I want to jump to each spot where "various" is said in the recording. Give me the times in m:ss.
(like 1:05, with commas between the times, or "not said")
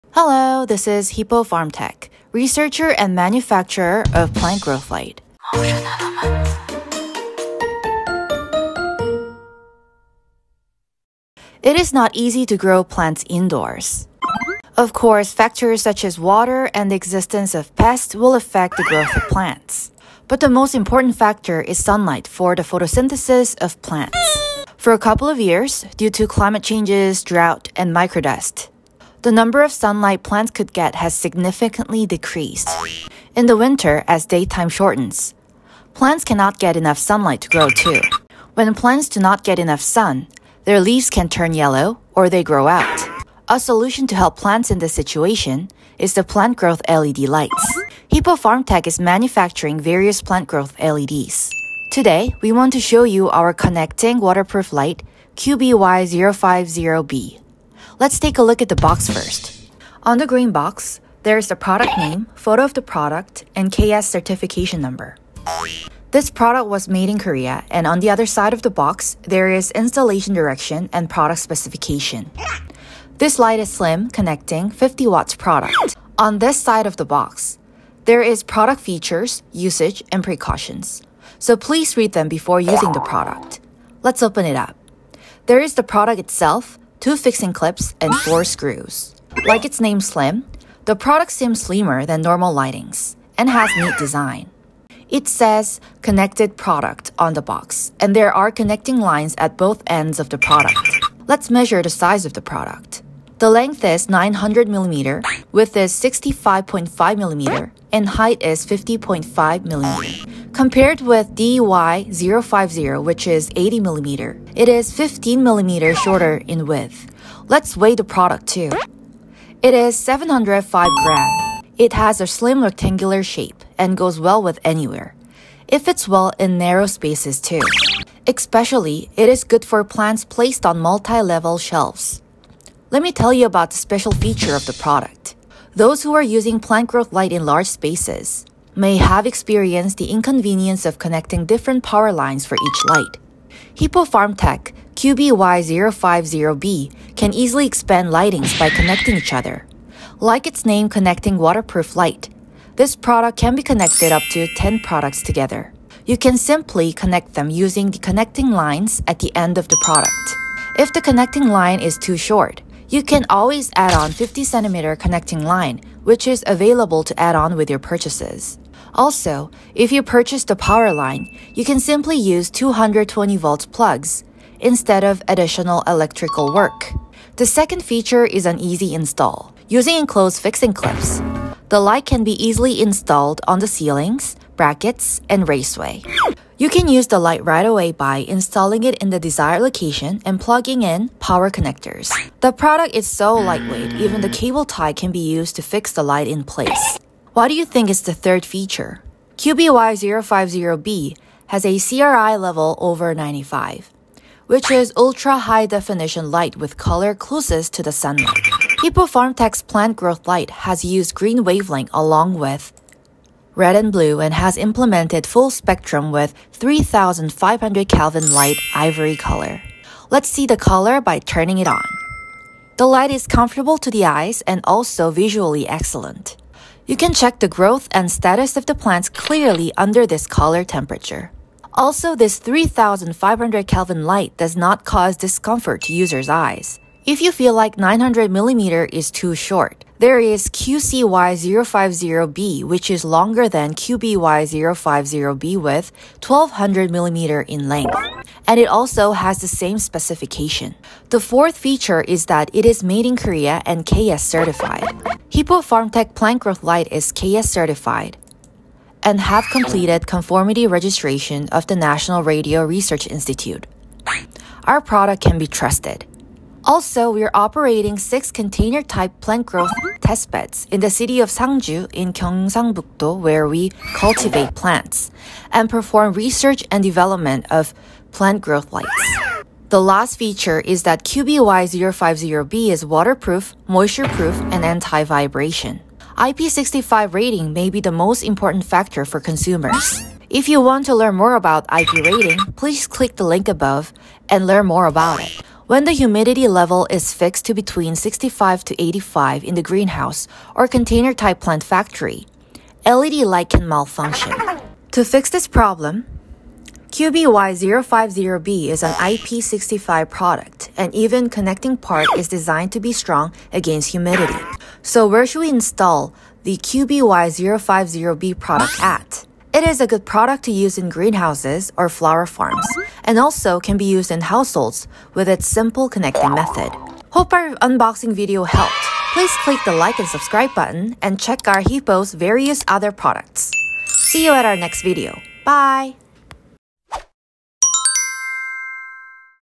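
0:49, 5:32.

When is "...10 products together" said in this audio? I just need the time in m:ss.
2:34.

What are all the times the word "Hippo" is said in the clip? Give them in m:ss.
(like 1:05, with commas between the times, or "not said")
0:01, 0:48, 2:23, 3:28, 4:15, 5:31.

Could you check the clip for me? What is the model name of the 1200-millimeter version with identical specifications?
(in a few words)
QCY050B.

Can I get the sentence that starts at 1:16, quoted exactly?
On this side of the box, there is product features, usage, and precautions.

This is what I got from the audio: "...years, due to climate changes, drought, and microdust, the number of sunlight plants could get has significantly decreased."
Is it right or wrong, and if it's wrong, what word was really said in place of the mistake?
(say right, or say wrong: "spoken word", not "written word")
right.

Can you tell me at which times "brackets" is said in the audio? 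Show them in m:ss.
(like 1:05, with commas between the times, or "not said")
3:04.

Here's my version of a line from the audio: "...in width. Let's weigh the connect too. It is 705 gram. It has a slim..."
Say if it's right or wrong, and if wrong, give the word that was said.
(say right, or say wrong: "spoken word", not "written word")
wrong: "product", not "connect".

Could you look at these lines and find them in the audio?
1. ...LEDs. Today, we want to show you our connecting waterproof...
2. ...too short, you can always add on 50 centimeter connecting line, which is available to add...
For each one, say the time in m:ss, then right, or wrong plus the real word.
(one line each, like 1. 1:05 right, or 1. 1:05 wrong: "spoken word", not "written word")
1. 0:50 right
2. 2:41 right.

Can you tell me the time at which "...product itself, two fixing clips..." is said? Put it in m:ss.
1:25.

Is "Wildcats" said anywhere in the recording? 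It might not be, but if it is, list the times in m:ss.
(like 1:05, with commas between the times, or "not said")
not said.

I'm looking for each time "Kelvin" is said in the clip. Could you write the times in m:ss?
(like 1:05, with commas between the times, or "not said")
3:37, 3:53.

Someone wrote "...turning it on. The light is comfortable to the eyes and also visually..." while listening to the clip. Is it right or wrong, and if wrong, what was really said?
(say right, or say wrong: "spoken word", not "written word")
right.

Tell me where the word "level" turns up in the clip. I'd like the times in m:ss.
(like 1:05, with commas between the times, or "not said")
2:10, 3:22, 4:56.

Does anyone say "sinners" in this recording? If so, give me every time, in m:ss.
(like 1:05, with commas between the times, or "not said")
not said.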